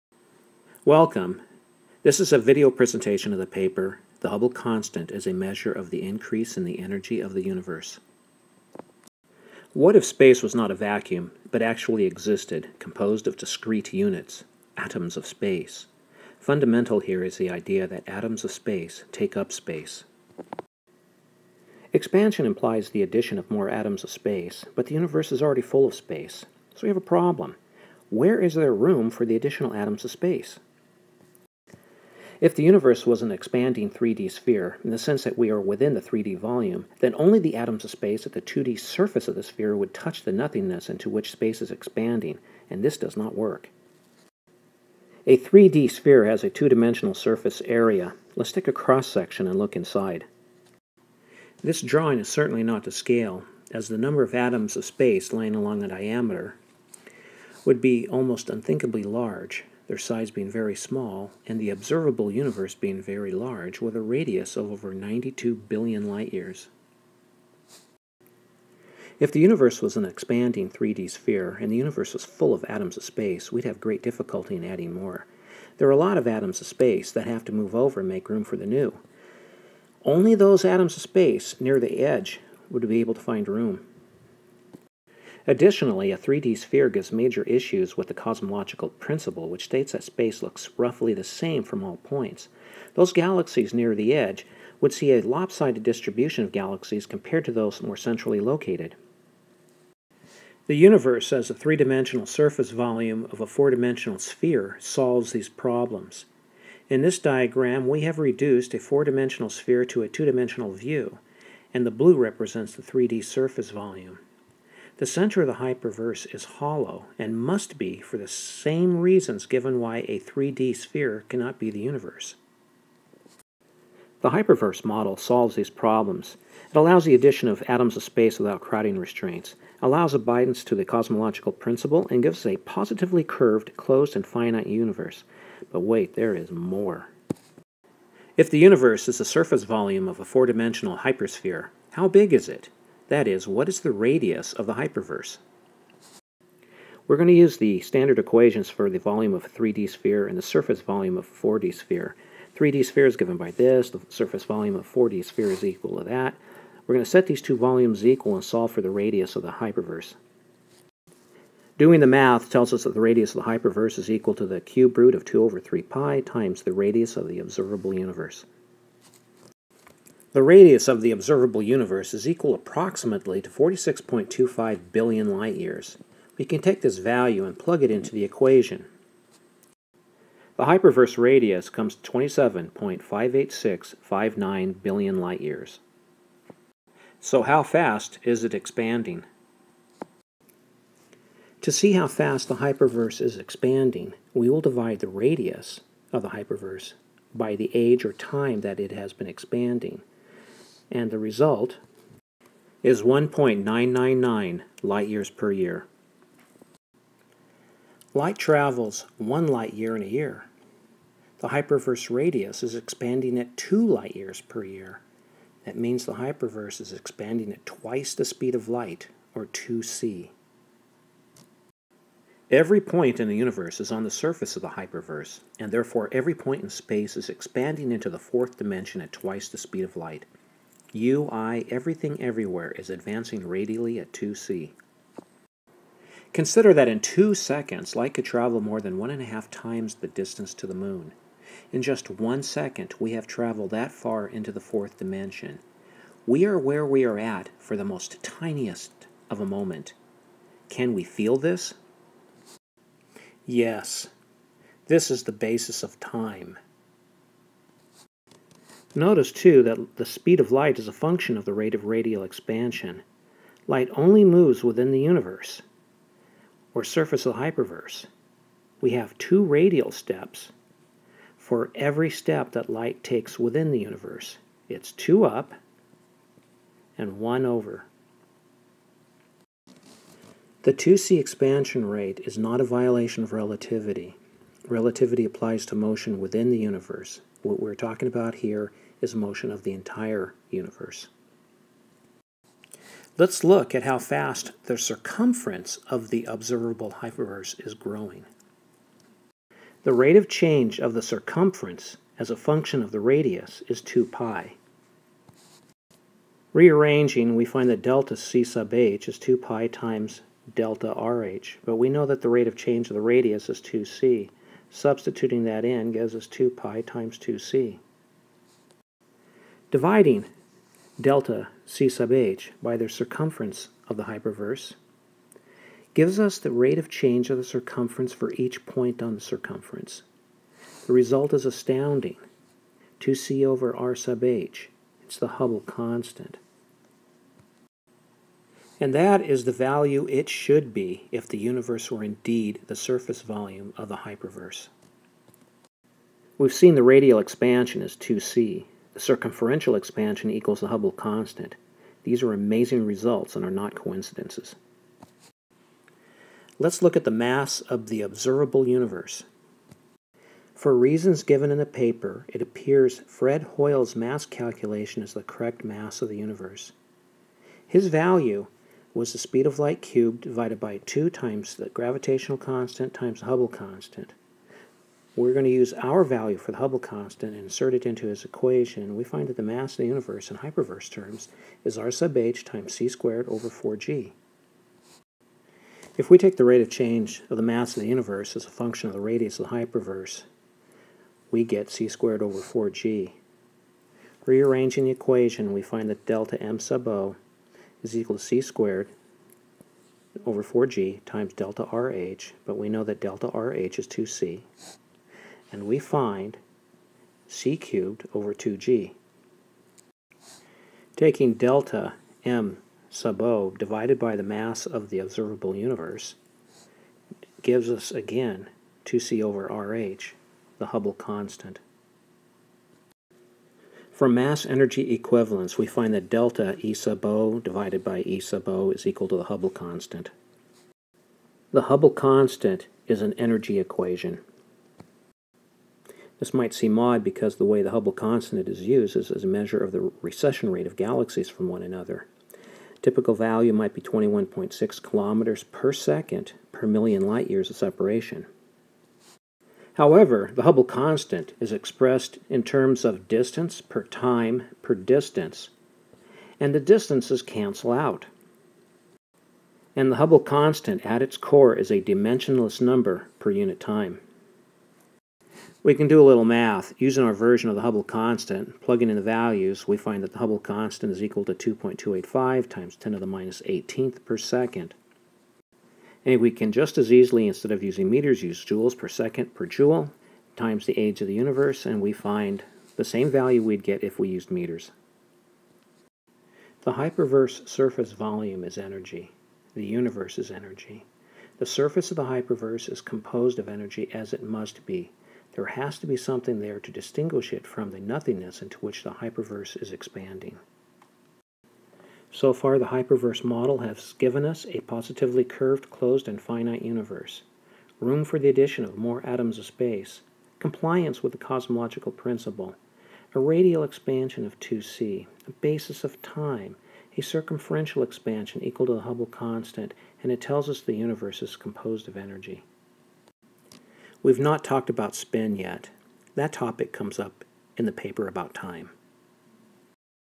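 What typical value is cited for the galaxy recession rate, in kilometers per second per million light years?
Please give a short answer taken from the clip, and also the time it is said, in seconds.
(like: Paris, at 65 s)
21.6, at 443 s.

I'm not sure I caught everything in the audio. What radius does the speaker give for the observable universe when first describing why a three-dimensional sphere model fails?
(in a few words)
over 92 billion light years.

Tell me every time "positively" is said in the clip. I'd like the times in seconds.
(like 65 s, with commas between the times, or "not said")
132 s, 504 s.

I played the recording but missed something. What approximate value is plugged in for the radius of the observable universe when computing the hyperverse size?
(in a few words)
46.25 billion light years.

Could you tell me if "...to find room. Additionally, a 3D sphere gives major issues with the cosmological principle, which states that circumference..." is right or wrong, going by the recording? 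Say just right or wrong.
wrong.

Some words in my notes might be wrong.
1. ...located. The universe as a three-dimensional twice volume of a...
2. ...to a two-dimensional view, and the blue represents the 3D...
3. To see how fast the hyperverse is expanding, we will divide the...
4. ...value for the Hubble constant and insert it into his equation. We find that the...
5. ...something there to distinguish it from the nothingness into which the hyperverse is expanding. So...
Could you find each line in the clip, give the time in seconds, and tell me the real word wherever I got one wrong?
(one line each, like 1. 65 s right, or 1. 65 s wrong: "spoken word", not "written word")
1. 98 s wrong: "surface", not "twice"
2. 109 s right
3. 191 s right
4. 376 s right
5. 495 s right.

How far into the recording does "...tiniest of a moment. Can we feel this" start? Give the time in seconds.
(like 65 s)
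248 s.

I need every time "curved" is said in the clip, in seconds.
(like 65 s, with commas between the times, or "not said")
133 s, 505 s.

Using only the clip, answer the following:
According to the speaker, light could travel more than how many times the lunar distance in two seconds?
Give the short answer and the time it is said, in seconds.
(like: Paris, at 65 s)
1.5 times, at 238 s.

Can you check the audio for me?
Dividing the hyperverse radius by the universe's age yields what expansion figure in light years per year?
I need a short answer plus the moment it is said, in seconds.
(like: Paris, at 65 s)
1.999, at 203 s.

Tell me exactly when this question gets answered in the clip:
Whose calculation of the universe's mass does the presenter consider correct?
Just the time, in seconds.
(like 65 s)
363 s.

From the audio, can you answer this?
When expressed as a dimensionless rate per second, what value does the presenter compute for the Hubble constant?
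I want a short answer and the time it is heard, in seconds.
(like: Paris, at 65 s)
2.285 × 10^-18 per second, at 471 s.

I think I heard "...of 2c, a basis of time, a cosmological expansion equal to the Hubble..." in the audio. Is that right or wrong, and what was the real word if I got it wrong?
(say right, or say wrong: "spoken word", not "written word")
wrong: "circumferential", not "cosmological".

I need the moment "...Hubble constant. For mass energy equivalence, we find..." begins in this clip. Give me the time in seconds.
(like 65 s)
420 s.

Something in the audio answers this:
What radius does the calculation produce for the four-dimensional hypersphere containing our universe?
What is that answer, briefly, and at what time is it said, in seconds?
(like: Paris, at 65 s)
27.58659 billion light years, at 182 s.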